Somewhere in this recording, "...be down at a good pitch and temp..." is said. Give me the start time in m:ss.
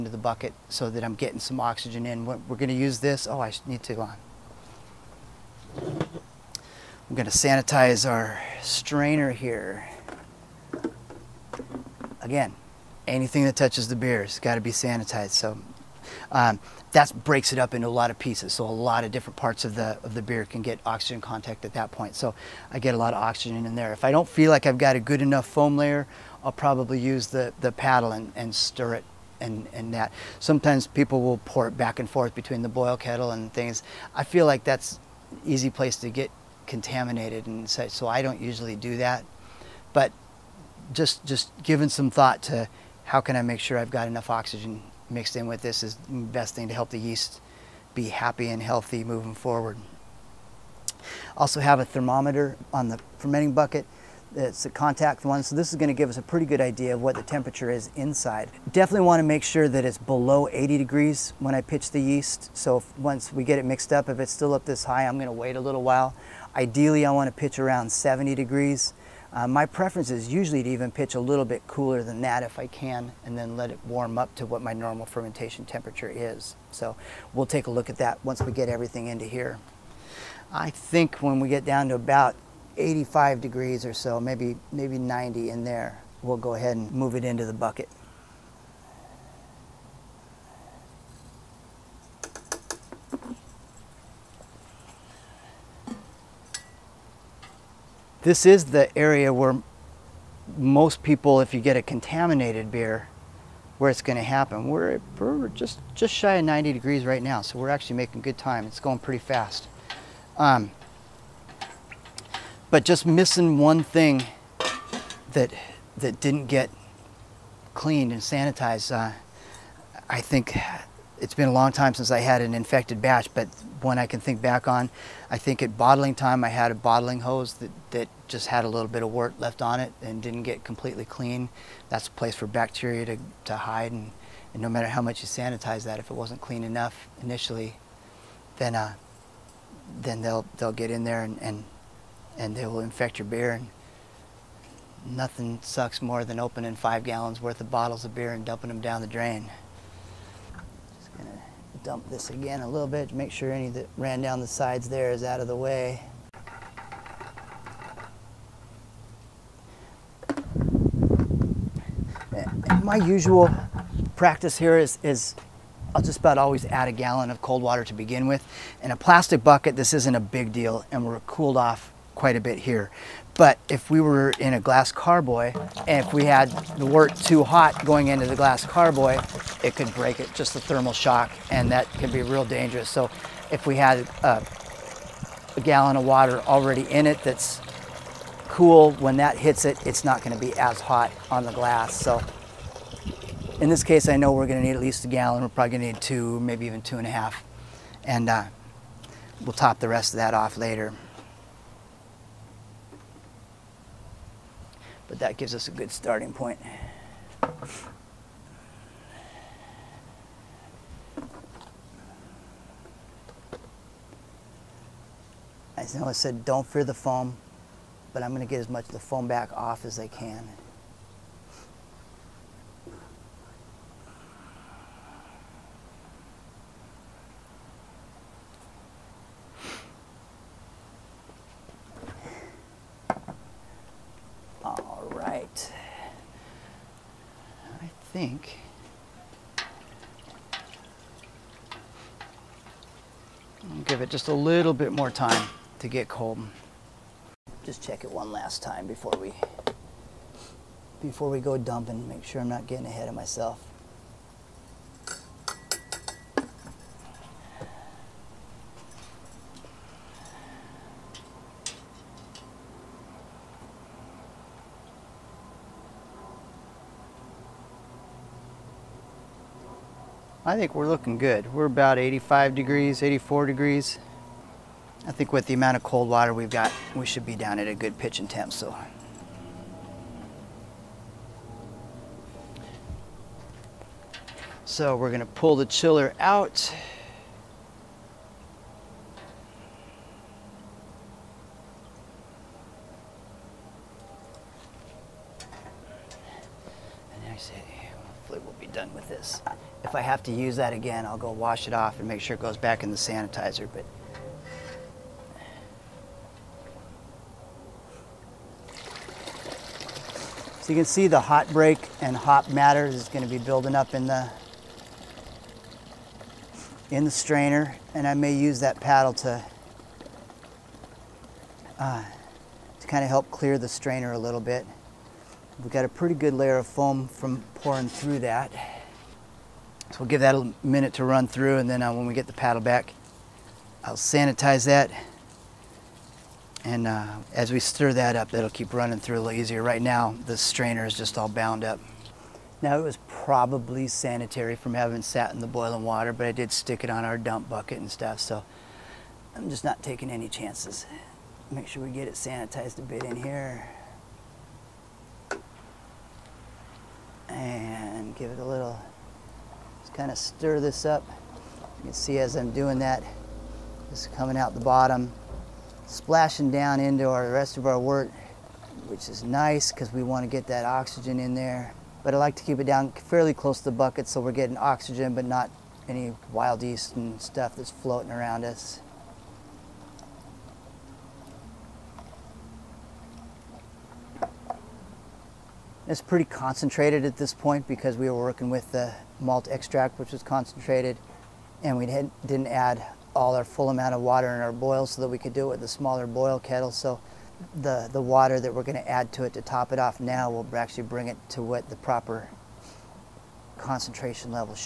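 4:37.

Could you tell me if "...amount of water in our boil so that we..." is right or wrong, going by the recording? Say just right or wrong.
right.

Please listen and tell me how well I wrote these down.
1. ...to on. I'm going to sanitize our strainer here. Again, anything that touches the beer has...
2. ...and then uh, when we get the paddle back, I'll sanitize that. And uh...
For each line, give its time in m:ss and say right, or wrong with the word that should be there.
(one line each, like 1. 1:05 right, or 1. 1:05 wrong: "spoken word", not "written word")
1. 0:03 right
2. 5:31 right.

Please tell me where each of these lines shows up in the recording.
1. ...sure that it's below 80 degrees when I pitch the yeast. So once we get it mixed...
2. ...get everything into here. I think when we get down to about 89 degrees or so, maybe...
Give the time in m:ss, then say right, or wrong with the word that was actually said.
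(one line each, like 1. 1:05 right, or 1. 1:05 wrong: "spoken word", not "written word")
1. 0:59 right
2. 1:18 wrong: "85", not "89".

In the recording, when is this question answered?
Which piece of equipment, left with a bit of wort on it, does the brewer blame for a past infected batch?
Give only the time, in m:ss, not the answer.
2:06.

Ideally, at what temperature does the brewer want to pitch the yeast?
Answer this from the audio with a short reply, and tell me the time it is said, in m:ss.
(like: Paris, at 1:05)
70 degrees, at 1:07.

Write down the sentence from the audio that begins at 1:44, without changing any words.
We're, we're, just, just shy of 90 degrees right now, so we're actually making good time.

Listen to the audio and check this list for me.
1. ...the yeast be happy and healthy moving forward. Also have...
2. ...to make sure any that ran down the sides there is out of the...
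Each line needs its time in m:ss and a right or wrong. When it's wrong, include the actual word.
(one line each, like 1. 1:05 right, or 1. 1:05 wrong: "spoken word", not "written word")
1. 0:46 right
2. 2:33 right.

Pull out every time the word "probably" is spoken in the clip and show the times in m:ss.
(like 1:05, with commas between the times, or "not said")
0:26, 3:15, 5:43.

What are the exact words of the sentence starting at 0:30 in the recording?
Sometimes people will pour it back and forth between the boil kettle and things.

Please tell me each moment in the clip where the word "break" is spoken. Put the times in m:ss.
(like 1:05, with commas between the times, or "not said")
0:17, 2:59, 5:11.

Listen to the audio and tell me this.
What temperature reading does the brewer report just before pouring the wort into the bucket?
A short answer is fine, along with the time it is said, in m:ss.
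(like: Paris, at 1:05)
84 degrees, at 4:33.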